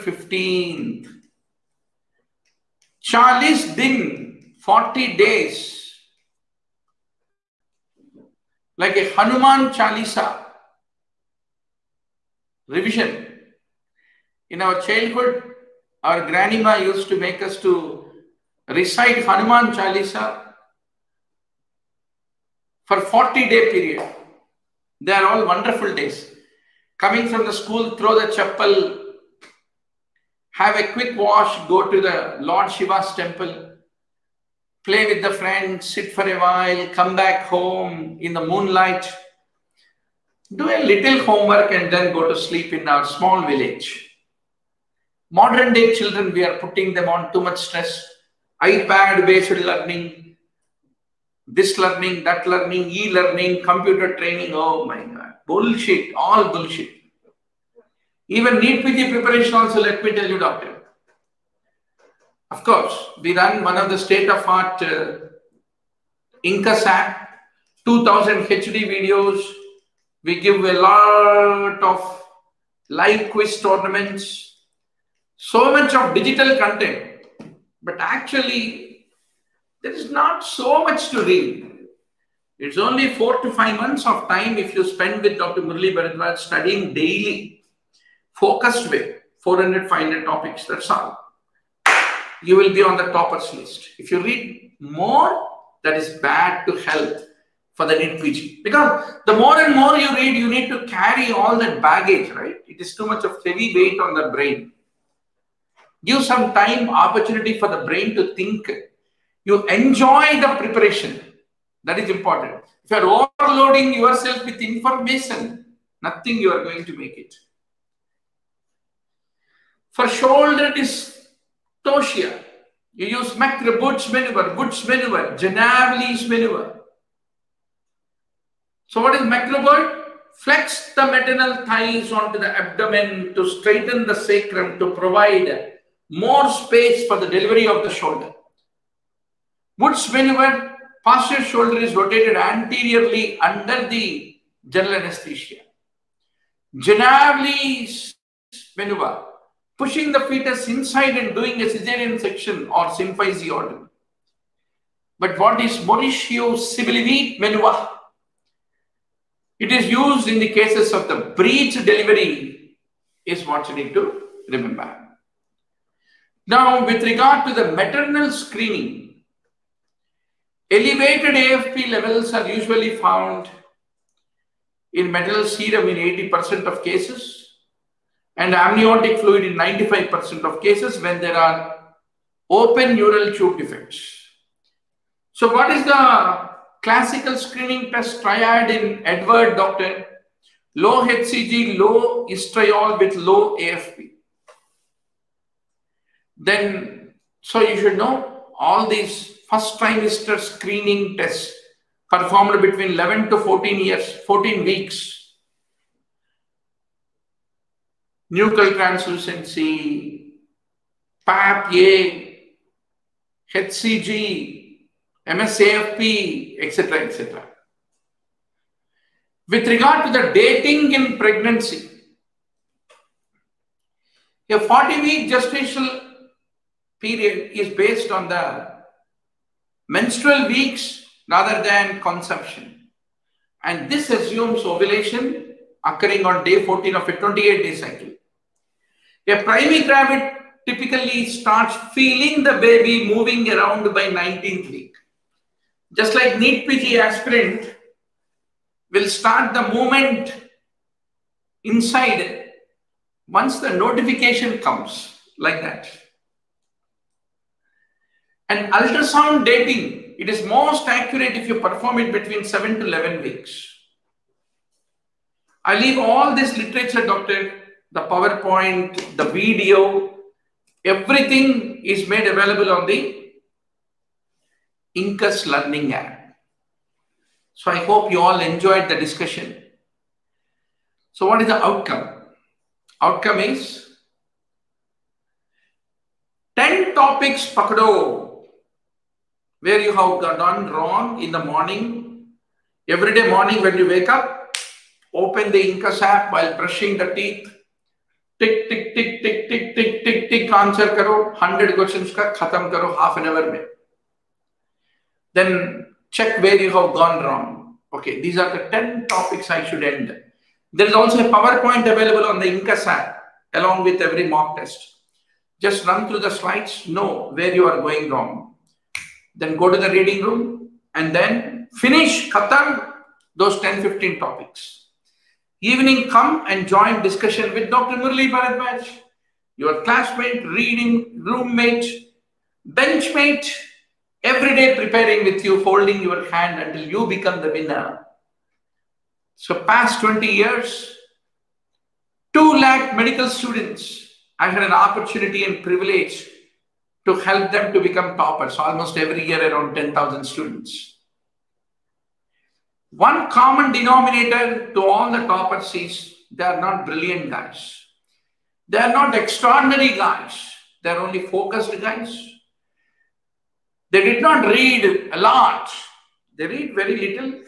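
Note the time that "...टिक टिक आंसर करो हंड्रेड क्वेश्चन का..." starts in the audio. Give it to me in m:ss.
5:00.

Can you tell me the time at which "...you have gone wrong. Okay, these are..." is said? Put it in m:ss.
5:06.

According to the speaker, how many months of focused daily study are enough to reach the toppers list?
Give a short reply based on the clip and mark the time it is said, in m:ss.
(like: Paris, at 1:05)
4 to 5, at 1:23.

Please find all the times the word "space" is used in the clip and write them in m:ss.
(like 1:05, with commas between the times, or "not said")
2:16.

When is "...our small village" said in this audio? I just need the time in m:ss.
0:42.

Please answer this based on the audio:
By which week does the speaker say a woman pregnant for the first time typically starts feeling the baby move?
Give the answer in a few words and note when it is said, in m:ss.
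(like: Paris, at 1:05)
19th week, at 4:04.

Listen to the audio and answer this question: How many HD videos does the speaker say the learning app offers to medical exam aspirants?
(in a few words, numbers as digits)
2000.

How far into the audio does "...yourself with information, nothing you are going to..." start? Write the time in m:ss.
1:53.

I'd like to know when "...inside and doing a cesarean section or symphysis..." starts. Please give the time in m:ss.
2:30.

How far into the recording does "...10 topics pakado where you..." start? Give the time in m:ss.
4:46.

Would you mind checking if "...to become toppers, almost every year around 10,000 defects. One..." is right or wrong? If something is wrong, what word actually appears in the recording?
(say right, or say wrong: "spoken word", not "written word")
wrong: "students", not "defects".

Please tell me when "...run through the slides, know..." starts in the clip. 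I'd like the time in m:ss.
5:15.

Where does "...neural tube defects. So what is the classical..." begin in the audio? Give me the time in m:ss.
3:02.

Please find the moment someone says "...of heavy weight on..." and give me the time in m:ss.
1:43.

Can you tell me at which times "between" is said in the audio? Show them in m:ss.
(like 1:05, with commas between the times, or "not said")
3:22, 4:22.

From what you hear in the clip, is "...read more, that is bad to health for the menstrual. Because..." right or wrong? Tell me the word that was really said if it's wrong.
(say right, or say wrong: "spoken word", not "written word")
wrong: "individual", not "menstrual".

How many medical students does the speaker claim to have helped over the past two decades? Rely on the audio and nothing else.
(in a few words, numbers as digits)
2 lakh.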